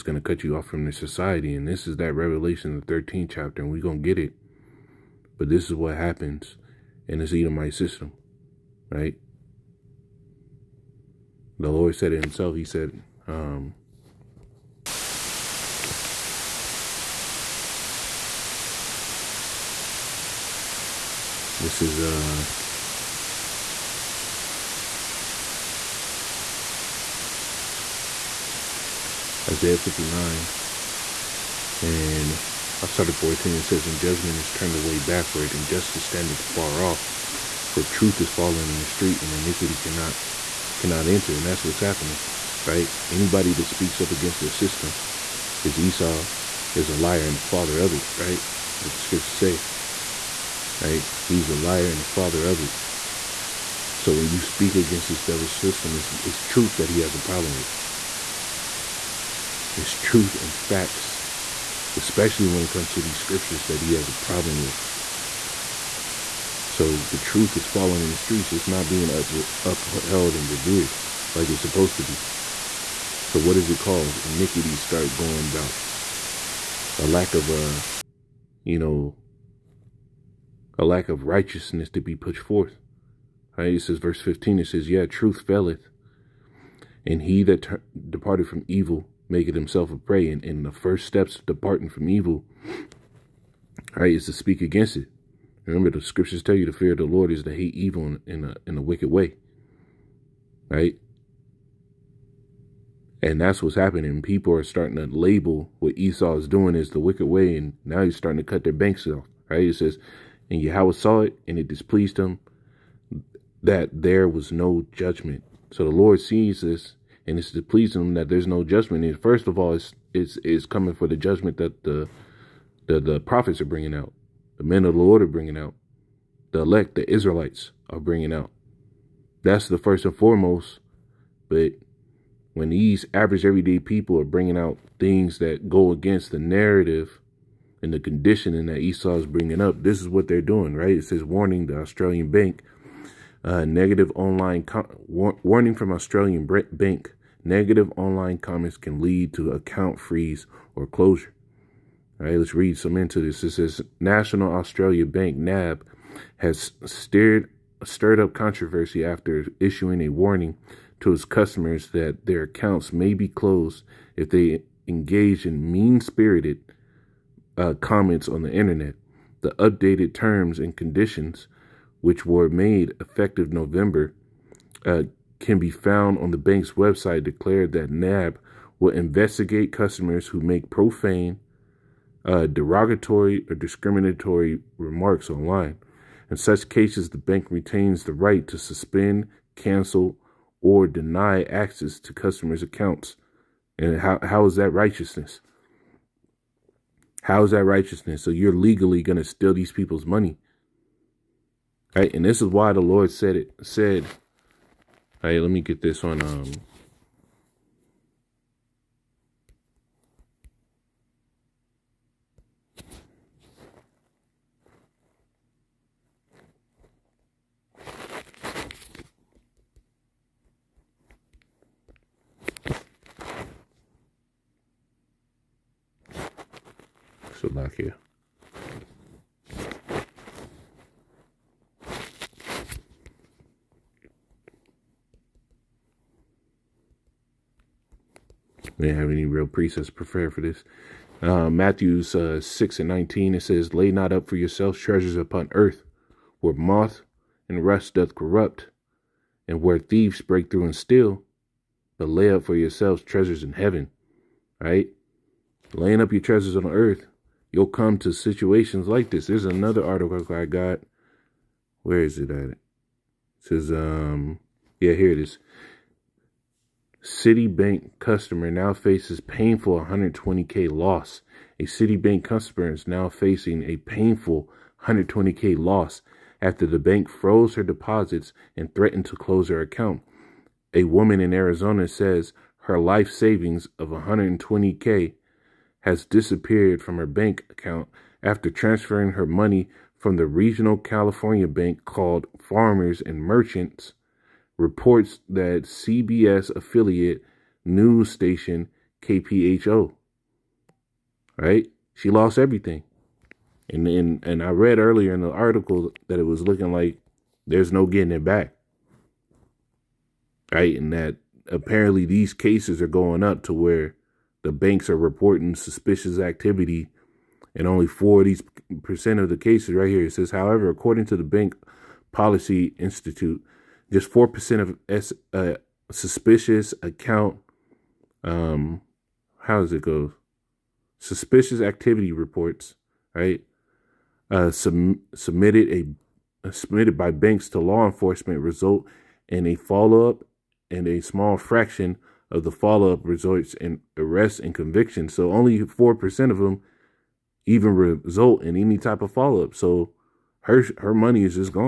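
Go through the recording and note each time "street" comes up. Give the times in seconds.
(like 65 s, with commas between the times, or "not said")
38 s, 68 s.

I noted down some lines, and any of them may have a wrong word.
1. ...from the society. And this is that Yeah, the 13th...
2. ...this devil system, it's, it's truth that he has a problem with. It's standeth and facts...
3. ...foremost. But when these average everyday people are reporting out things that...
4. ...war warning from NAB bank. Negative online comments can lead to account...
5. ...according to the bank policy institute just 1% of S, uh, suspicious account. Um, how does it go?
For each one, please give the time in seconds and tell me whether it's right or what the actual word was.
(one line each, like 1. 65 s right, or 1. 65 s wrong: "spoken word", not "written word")
1. 0 s wrong: "Revelation", not "Yeah"
2. 55 s wrong: "truth", not "standeth"
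3. 130 s wrong: "bringing", not "reporting"
4. 145 s wrong: "Australian", not "NAB"
5. 320 s wrong: "4", not "1".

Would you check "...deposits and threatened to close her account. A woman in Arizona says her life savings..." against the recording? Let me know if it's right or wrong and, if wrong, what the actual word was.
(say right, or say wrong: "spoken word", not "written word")
right.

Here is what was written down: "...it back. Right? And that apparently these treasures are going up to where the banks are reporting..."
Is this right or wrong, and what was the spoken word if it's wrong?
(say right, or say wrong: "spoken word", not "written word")
wrong: "cases", not "treasures".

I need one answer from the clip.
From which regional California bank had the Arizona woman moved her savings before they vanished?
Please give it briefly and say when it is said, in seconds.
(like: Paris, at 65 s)
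Farmers and Merchants, at 292 s.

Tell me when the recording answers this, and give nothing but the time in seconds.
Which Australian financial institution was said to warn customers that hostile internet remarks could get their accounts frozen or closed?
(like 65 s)
154 s.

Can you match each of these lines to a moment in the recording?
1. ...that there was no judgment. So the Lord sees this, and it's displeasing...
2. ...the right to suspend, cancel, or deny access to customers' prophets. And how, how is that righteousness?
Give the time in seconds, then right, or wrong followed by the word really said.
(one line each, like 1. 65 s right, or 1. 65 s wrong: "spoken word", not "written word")
1. 113 s right
2. 188 s wrong: "accounts", not "prophets".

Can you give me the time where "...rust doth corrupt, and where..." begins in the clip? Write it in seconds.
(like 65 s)
247 s.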